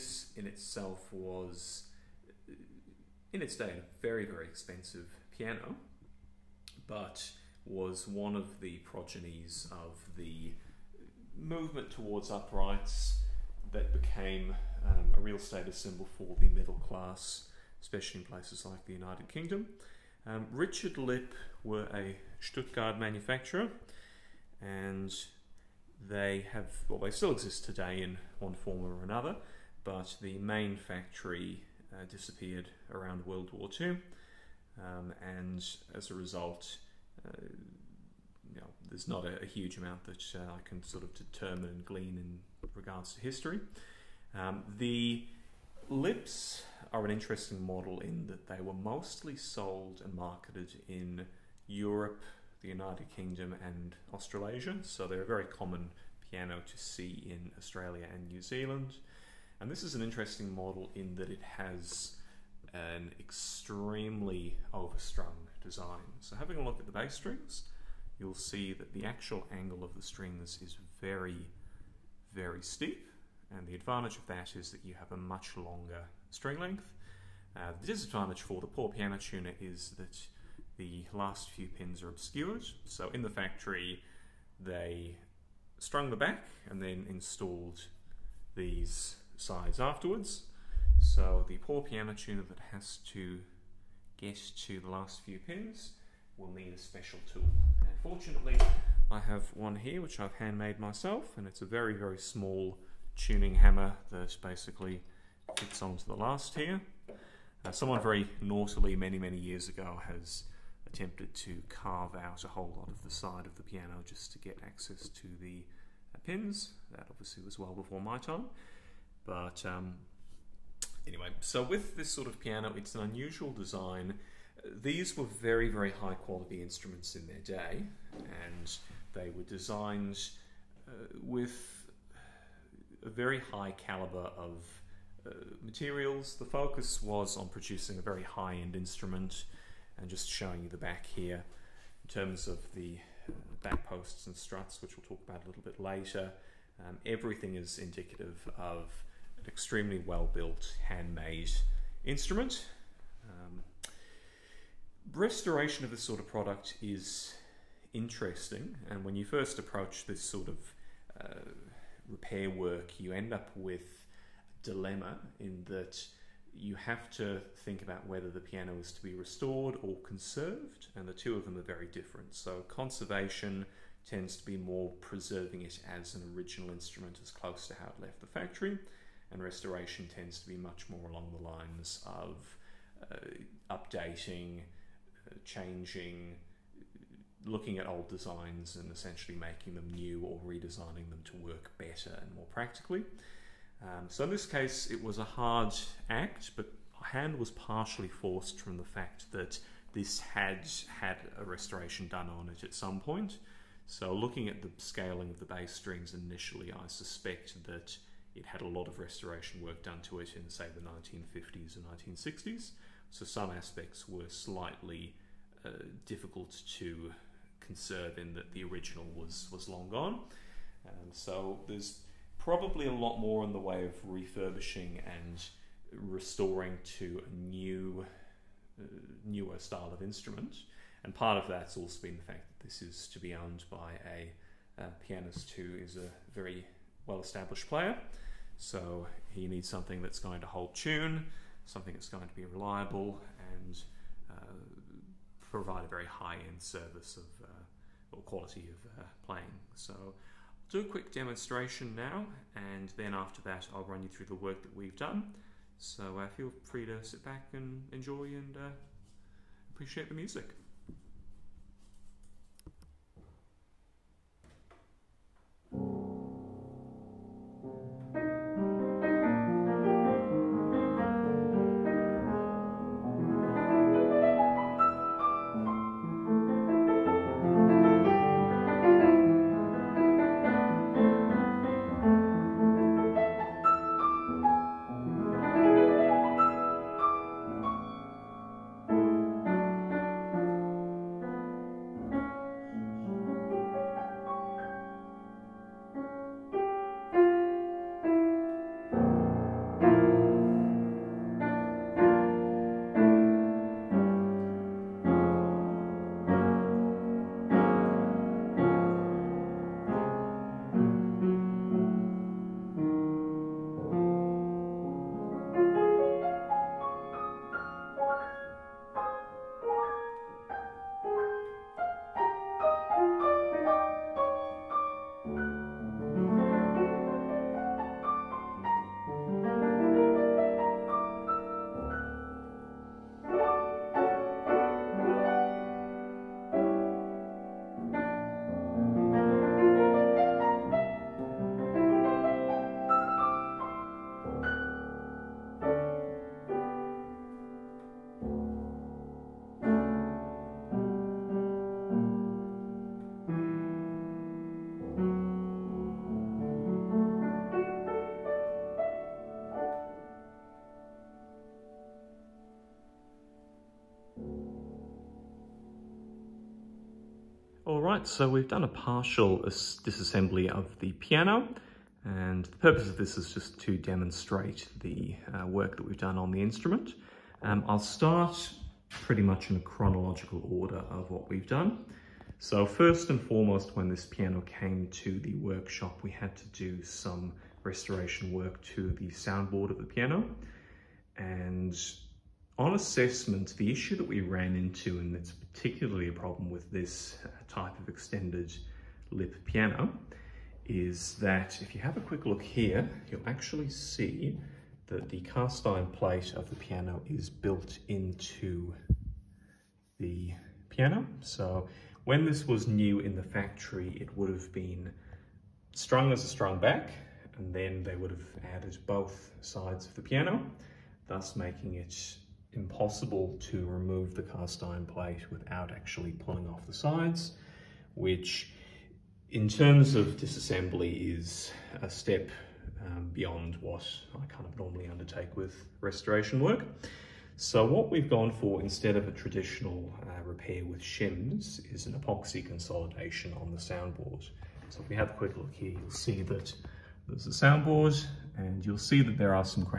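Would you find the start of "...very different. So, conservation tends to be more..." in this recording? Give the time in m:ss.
2:51.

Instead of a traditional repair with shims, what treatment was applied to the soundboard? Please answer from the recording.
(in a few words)
epoxy consolidation.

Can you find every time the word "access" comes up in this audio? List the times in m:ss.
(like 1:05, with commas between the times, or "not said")
1:54.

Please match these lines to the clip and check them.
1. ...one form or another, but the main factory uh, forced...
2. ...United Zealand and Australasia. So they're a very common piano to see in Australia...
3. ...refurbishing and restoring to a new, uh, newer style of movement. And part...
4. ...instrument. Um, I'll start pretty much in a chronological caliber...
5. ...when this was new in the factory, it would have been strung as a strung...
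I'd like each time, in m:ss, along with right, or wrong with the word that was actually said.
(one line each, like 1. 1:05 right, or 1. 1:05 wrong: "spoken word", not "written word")
1. 0:28 wrong: "disappeared", not "forced"
2. 0:52 wrong: "Kingdom", not "Zealand"
3. 3:44 wrong: "instrument", not "movement"
4. 6:16 wrong: "order", not "caliber"
5. 6:52 right.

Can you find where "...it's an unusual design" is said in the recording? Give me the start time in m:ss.
2:02.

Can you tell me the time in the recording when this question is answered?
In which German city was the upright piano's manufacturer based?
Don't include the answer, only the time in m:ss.
0:22.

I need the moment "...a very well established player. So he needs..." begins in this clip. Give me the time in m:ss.
3:55.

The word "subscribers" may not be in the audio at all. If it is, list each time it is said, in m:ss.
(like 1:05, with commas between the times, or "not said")
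not said.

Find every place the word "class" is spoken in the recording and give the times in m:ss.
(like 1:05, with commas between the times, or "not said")
0:16.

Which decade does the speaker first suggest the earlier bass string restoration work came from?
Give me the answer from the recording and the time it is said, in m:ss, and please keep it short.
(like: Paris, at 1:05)
1950s, at 3:30.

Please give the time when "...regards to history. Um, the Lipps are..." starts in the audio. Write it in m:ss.
0:42.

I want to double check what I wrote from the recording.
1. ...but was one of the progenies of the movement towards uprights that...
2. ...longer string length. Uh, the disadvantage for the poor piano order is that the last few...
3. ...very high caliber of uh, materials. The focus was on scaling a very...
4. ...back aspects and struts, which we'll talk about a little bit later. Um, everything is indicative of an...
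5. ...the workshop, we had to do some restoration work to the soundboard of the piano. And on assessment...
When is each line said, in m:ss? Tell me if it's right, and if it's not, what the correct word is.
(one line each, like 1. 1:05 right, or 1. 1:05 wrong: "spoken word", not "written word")
1. 0:06 right
2. 1:15 wrong: "tuner", not "order"
3. 2:13 wrong: "producing", not "scaling"
4. 2:23 wrong: "posts", not "aspects"
5. 6:25 right.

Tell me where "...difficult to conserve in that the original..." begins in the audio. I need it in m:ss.
3:36.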